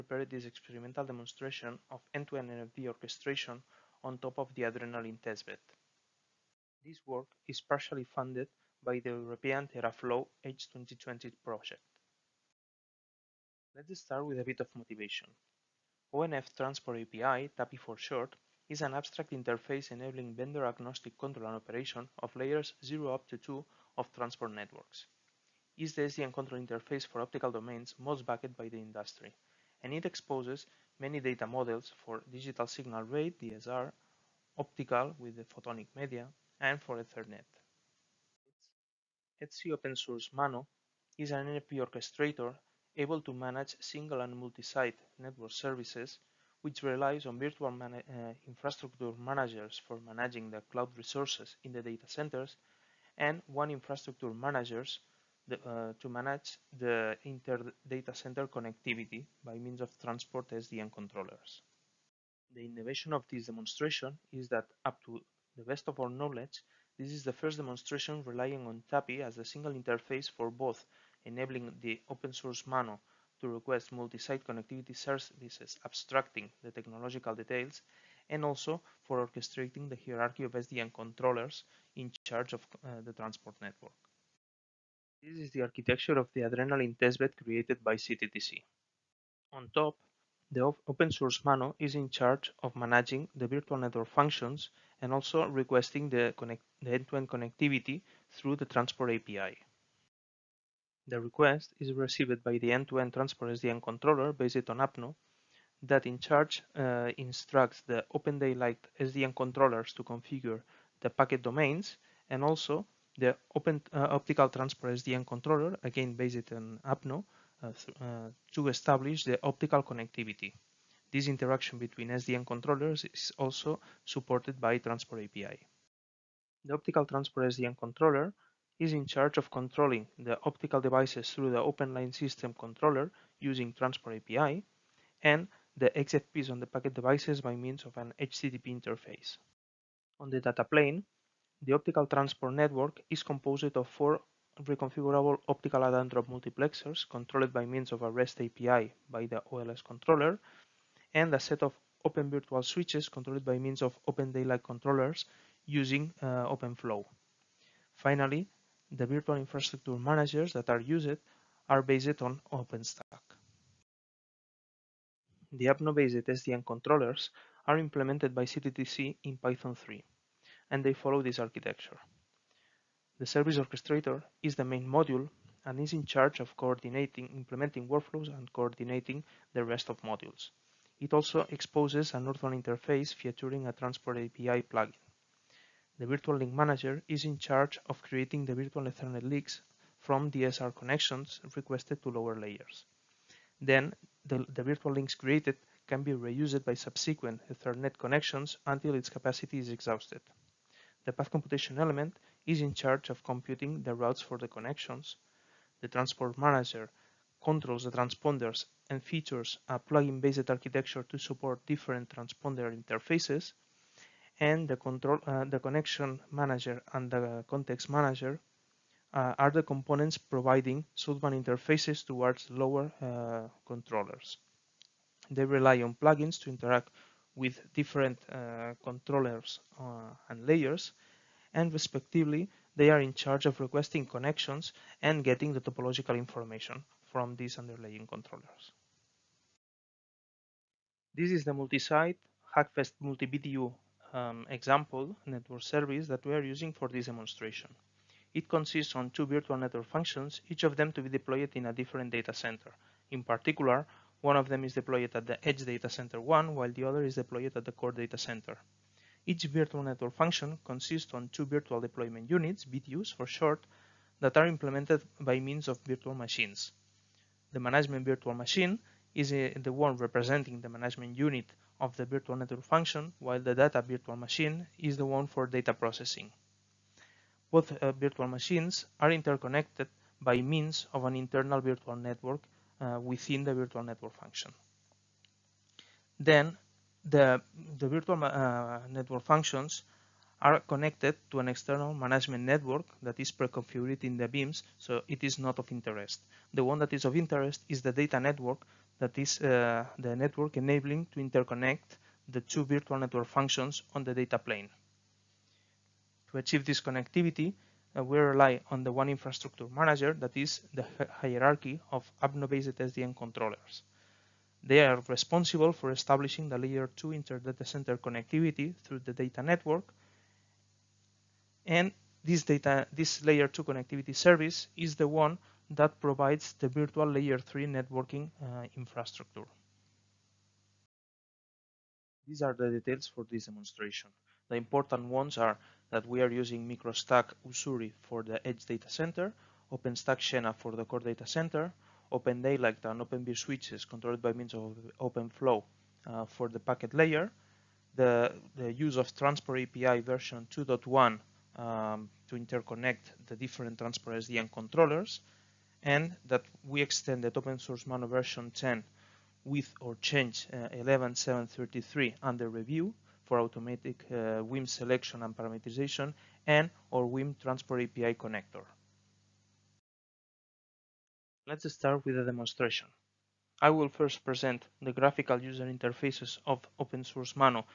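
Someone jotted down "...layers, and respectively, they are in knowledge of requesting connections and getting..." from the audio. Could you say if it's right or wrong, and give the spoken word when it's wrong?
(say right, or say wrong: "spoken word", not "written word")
wrong: "charge", not "knowledge".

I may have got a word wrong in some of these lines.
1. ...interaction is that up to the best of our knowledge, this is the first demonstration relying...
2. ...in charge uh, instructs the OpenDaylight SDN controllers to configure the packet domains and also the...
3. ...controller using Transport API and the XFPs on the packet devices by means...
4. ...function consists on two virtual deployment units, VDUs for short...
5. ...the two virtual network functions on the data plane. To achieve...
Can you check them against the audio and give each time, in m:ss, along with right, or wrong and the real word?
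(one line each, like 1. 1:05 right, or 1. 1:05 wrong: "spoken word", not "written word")
1. 1:03 wrong: "demonstration", not "interaction"
2. 1:46 right
3. 2:12 right
4. 4:20 right
5. 5:02 right.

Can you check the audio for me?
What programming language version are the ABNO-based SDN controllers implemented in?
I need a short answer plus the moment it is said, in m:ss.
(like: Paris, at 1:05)
Python 3, at 2:49.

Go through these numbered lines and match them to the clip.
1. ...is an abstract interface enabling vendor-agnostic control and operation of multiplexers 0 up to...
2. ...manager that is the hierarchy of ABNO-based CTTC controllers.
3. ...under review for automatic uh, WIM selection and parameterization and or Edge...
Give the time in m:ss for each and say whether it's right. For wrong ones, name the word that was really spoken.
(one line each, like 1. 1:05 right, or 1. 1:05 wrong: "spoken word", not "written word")
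1. 0:18 wrong: "layers", not "multiplexers"
2. 5:09 wrong: "SDN", not "CTTC"
3. 6:02 wrong: "WIM", not "Edge".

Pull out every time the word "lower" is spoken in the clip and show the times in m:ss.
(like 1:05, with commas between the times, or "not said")
3:12, 3:42.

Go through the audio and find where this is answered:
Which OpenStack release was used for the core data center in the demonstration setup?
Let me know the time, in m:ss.
5:40.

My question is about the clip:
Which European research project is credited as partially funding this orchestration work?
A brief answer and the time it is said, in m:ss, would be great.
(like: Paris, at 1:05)
TeraFlow, at 0:09.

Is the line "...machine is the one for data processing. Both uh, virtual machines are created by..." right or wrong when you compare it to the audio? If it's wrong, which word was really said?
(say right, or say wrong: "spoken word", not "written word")
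wrong: "interconnected", not "created".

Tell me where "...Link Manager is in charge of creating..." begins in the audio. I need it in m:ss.
3:06.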